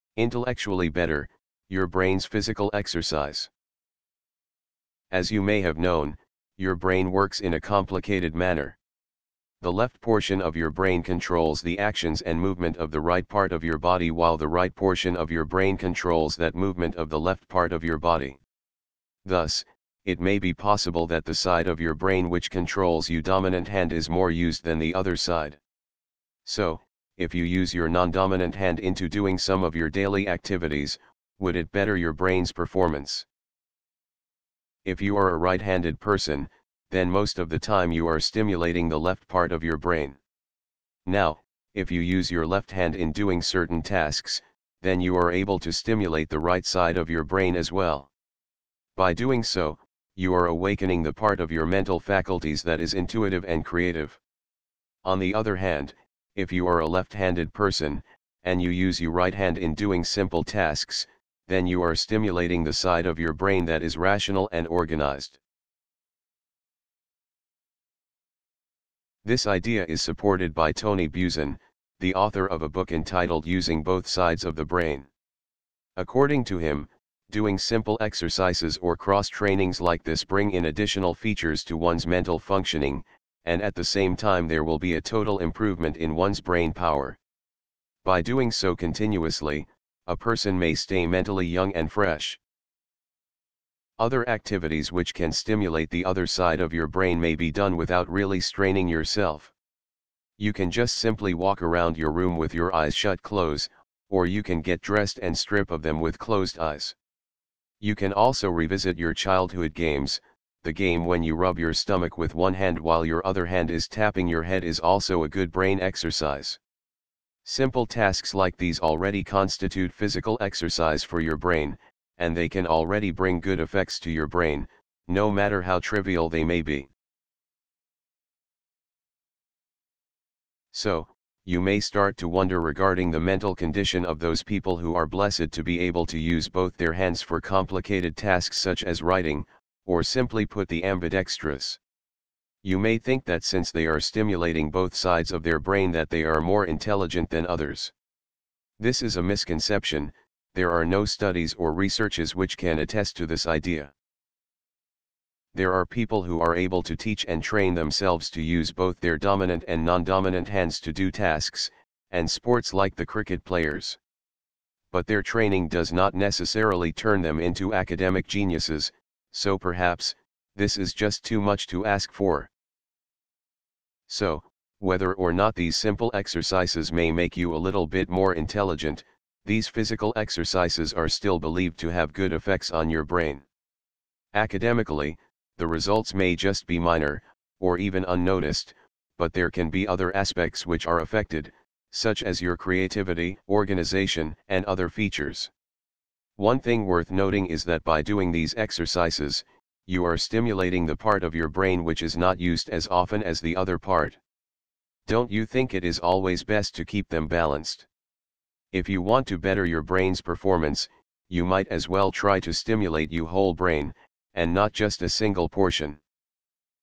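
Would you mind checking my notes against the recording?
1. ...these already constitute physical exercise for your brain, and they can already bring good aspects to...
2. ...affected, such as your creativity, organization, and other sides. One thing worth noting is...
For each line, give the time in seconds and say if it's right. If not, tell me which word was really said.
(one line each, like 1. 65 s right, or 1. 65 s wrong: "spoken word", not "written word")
1. 118 s wrong: "effects", not "aspects"
2. 190 s wrong: "features", not "sides".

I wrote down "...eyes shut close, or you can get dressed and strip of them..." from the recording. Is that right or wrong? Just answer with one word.
right.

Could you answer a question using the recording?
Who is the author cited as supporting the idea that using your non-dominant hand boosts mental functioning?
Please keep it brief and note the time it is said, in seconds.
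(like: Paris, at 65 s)
Tony Buzan, at 70 s.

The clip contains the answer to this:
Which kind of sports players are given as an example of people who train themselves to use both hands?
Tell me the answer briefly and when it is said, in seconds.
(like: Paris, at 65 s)
cricket players, at 163 s.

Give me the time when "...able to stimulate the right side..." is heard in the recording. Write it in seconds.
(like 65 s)
45 s.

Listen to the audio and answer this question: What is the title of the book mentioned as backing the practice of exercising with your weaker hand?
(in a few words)
Using Both Sides of the Brain.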